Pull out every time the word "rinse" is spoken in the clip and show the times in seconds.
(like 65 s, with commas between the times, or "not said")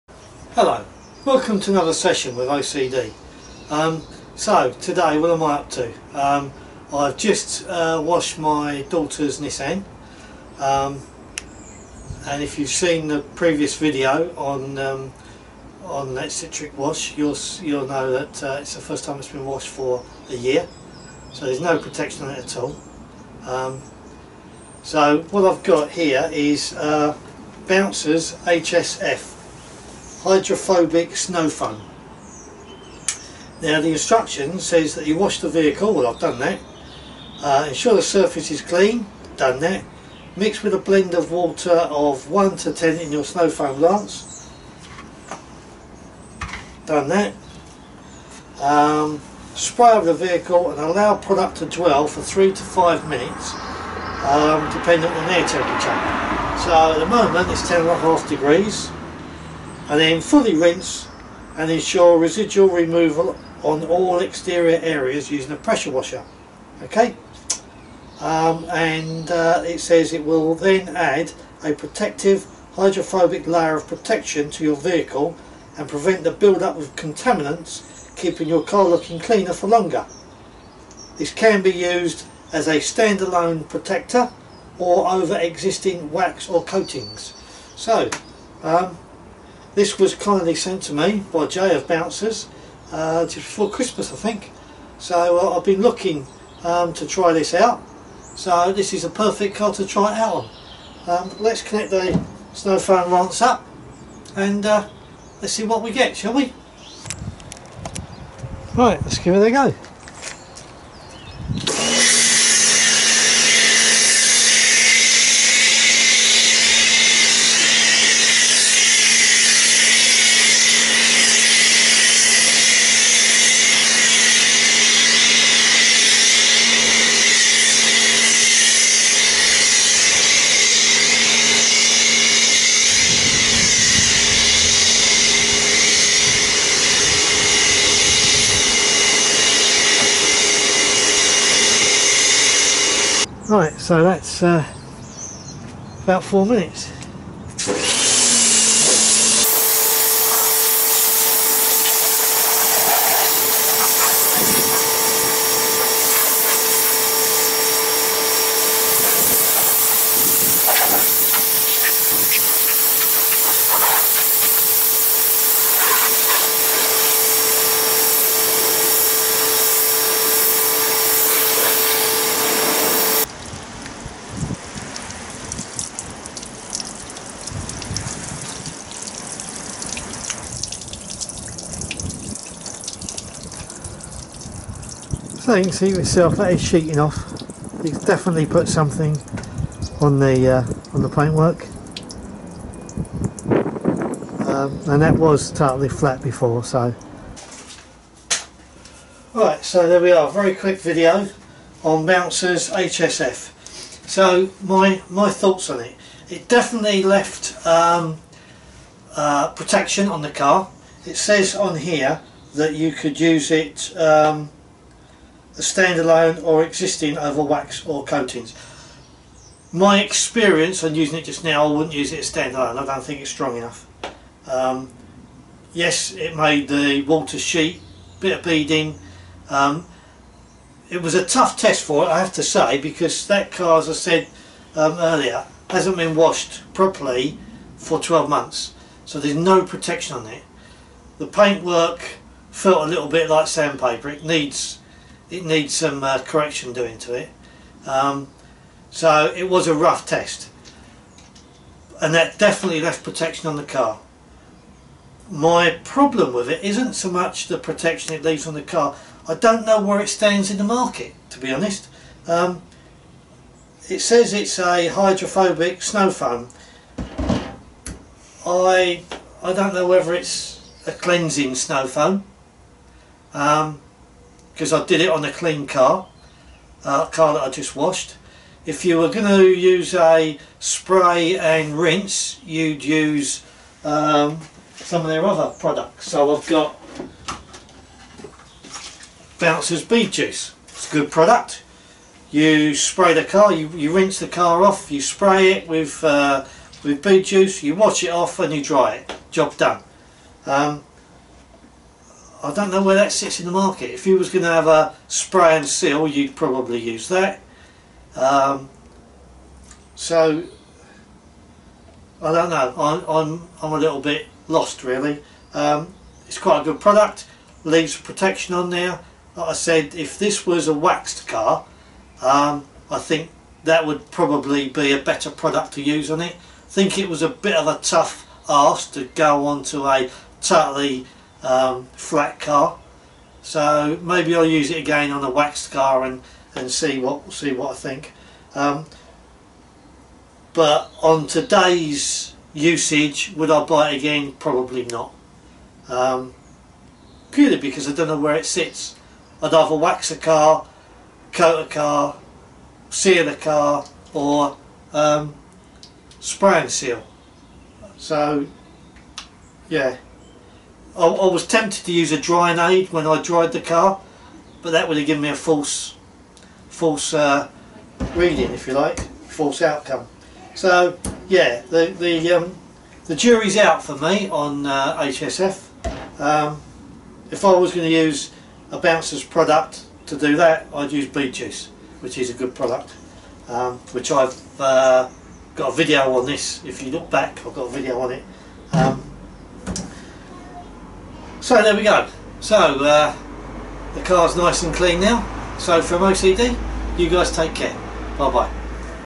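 60 s, 281 s, 293 s.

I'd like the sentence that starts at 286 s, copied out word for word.
So I've got Bouncer's Bee Juice.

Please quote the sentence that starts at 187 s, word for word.
It's definitely put something on the uh, on the paintwork.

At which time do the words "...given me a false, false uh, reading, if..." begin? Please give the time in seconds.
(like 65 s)
365 s.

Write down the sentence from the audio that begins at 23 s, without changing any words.
Um, so what I've got here is uh, Bouncers HSF hydrophobic snow foam.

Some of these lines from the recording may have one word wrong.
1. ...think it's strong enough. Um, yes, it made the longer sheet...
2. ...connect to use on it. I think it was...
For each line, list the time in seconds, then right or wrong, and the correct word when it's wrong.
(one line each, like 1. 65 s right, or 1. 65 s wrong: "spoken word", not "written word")
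1. 223 s wrong: "water", not "longer"
2. 325 s wrong: "product", not "connect".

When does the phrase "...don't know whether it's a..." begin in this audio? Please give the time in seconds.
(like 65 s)
269 s.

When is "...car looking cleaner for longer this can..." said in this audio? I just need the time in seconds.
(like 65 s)
78 s.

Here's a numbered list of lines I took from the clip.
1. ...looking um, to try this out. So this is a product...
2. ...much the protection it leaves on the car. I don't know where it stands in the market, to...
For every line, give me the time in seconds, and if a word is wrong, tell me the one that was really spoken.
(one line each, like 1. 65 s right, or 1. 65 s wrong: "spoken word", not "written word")
1. 95 s wrong: "perfect", not "product"
2. 257 s right.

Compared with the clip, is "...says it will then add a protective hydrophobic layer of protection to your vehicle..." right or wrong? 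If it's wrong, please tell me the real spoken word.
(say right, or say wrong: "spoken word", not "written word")
right.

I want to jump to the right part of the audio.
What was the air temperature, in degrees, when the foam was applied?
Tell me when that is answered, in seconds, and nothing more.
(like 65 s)
57 s.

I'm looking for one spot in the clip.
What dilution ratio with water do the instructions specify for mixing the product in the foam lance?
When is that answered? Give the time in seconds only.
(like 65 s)
42 s.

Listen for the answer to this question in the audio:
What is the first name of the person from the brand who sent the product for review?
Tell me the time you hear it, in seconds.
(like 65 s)
91 s.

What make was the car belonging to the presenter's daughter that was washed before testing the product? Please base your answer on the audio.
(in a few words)
Nissan.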